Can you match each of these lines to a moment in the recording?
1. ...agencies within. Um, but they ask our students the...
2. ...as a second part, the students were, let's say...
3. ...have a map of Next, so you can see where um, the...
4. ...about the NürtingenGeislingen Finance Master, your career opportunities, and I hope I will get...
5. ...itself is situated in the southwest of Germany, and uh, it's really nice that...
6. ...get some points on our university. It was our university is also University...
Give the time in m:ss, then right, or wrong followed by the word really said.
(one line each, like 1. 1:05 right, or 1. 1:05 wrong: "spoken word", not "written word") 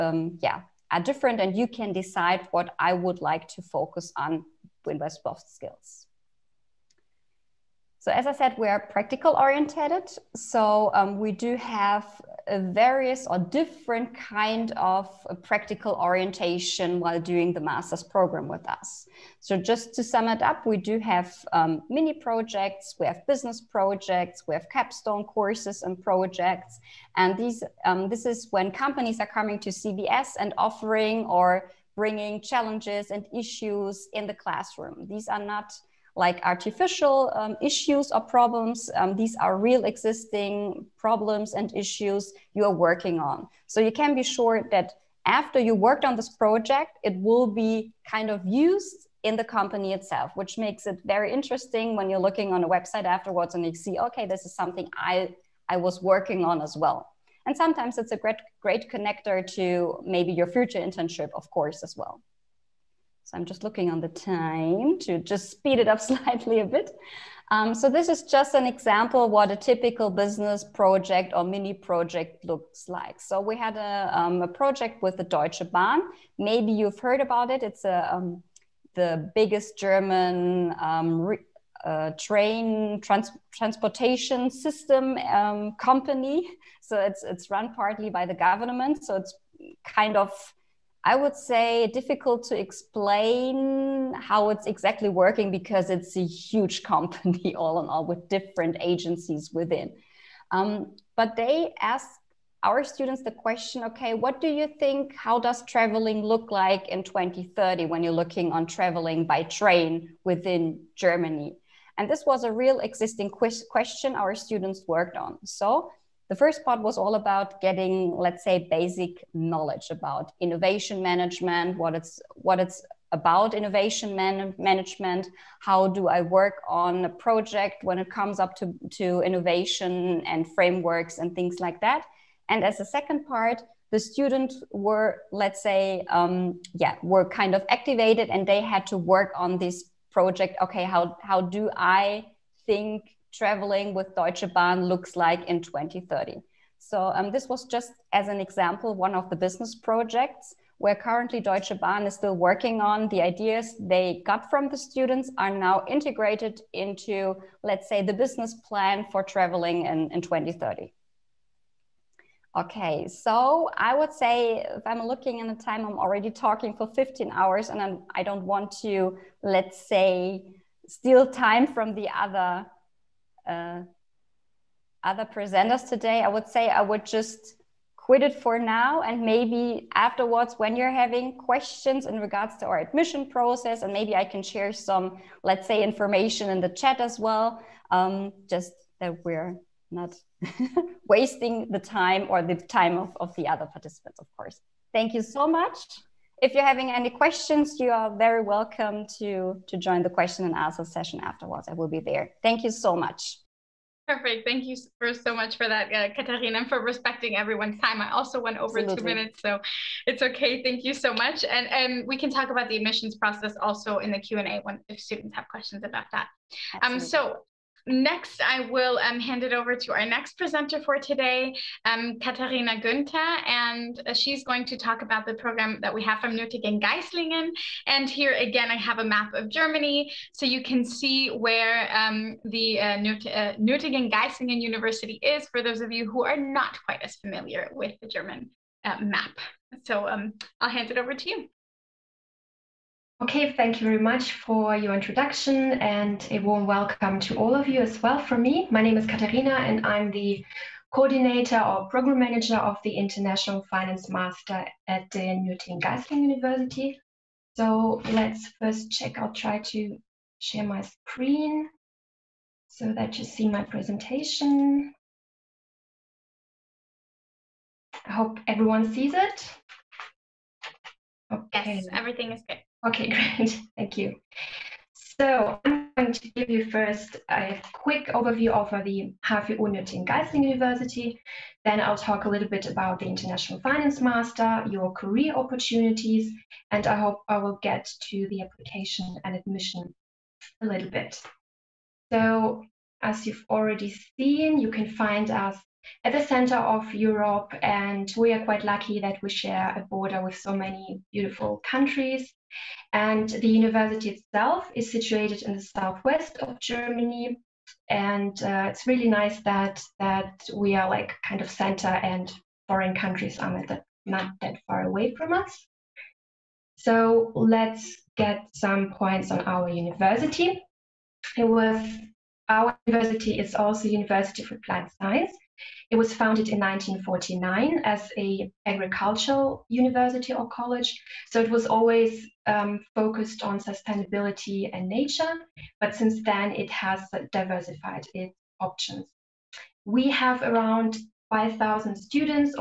1. 1:38 right
2. 2:12 right
3. 3:48 wrong: "Germany", not "Next"
4. 4:42 wrong: "International", not "NürtingenGeislingen"
5. 5:04 right
6. 5:18 right.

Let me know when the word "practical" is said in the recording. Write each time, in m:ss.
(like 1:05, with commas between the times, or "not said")
0:08, 0:15.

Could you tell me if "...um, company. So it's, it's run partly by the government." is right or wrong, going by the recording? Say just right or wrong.
right.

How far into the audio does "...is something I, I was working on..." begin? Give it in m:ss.
0:54.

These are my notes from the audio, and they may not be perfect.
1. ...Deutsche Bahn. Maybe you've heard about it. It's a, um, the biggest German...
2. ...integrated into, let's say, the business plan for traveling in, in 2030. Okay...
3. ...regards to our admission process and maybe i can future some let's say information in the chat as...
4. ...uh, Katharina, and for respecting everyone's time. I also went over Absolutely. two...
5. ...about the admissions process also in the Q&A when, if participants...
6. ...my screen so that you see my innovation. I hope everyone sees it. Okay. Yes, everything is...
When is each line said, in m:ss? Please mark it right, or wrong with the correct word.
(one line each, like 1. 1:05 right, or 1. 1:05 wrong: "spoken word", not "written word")
1. 1:15 right
2. 2:35 right
3. 3:02 wrong: "share", not "future"
4. 3:25 right
5. 3:32 wrong: "students", not "participants"
6. 4:20 wrong: "presentation", not "innovation".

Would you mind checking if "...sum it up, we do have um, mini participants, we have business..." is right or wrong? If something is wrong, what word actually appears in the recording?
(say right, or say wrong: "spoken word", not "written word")
wrong: "projects", not "participants".